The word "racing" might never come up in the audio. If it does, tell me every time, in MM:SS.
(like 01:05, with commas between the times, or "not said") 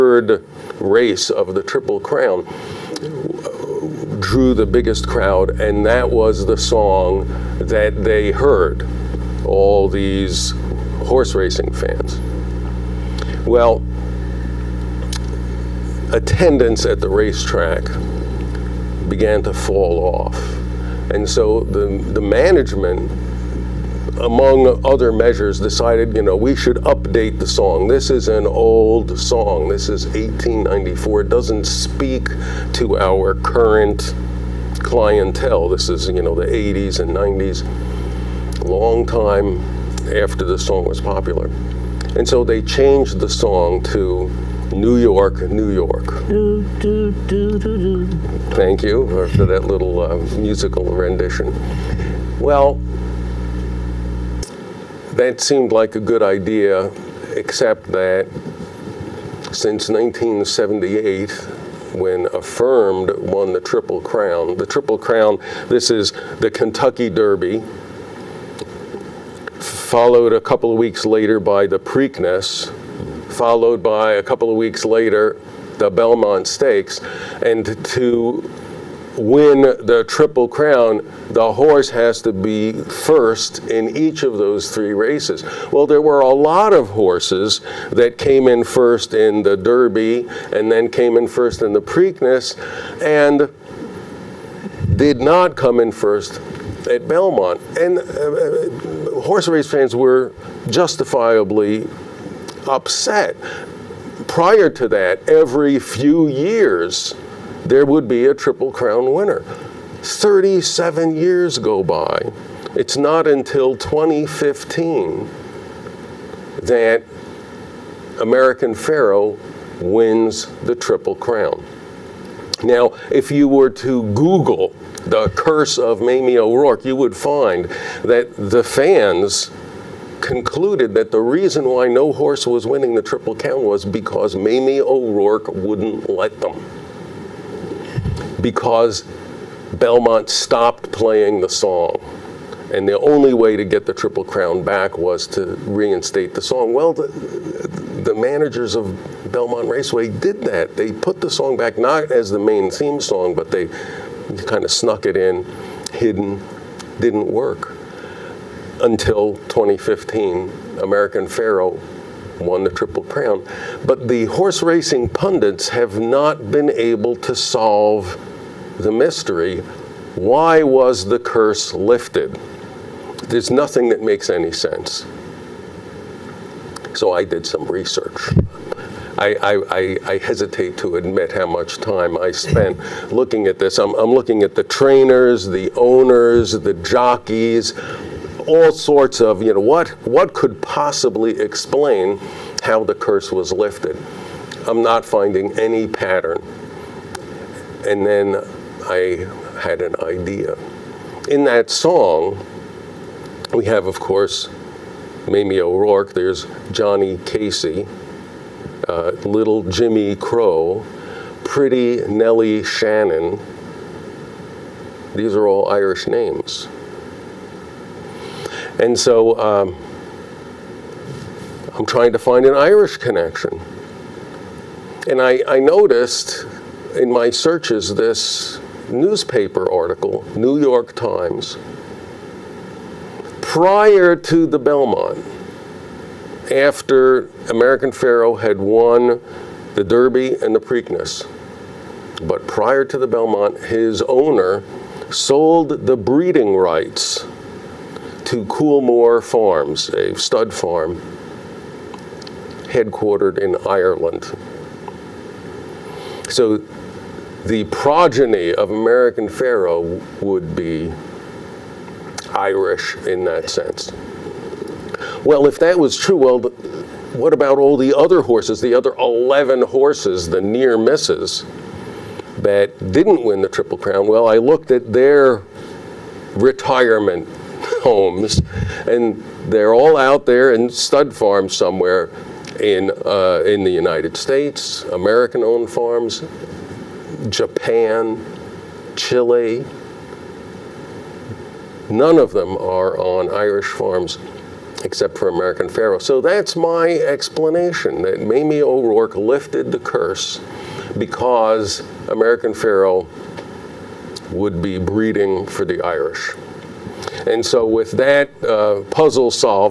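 00:11, 02:44.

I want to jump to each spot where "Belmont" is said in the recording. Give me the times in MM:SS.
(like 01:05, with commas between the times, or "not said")
01:15, 01:37, 02:19, 02:29, 03:54, 04:03.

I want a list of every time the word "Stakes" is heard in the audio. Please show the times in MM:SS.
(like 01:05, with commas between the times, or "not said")
01:16.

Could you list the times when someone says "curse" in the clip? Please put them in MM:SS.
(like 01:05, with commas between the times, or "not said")
02:05, 02:51, 03:12, 04:59.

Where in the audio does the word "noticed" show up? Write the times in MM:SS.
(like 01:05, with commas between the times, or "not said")
03:45.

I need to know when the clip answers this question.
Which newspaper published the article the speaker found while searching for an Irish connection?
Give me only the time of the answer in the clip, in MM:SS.
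03:50.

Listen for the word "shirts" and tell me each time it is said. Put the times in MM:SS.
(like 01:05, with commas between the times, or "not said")
not said.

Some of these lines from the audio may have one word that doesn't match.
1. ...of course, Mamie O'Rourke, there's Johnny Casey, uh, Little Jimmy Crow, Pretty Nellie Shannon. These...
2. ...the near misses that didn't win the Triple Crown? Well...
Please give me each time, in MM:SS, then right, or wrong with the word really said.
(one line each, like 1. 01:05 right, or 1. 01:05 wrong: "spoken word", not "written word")
1. 03:23 right
2. 04:30 right.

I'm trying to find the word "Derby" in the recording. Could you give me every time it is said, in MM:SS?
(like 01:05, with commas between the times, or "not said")
01:07, 01:29, 03:59.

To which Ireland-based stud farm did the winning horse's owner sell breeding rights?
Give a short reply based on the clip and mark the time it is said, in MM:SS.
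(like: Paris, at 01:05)
Coolmore Farms, at 04:08.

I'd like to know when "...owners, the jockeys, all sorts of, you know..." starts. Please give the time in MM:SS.
03:05.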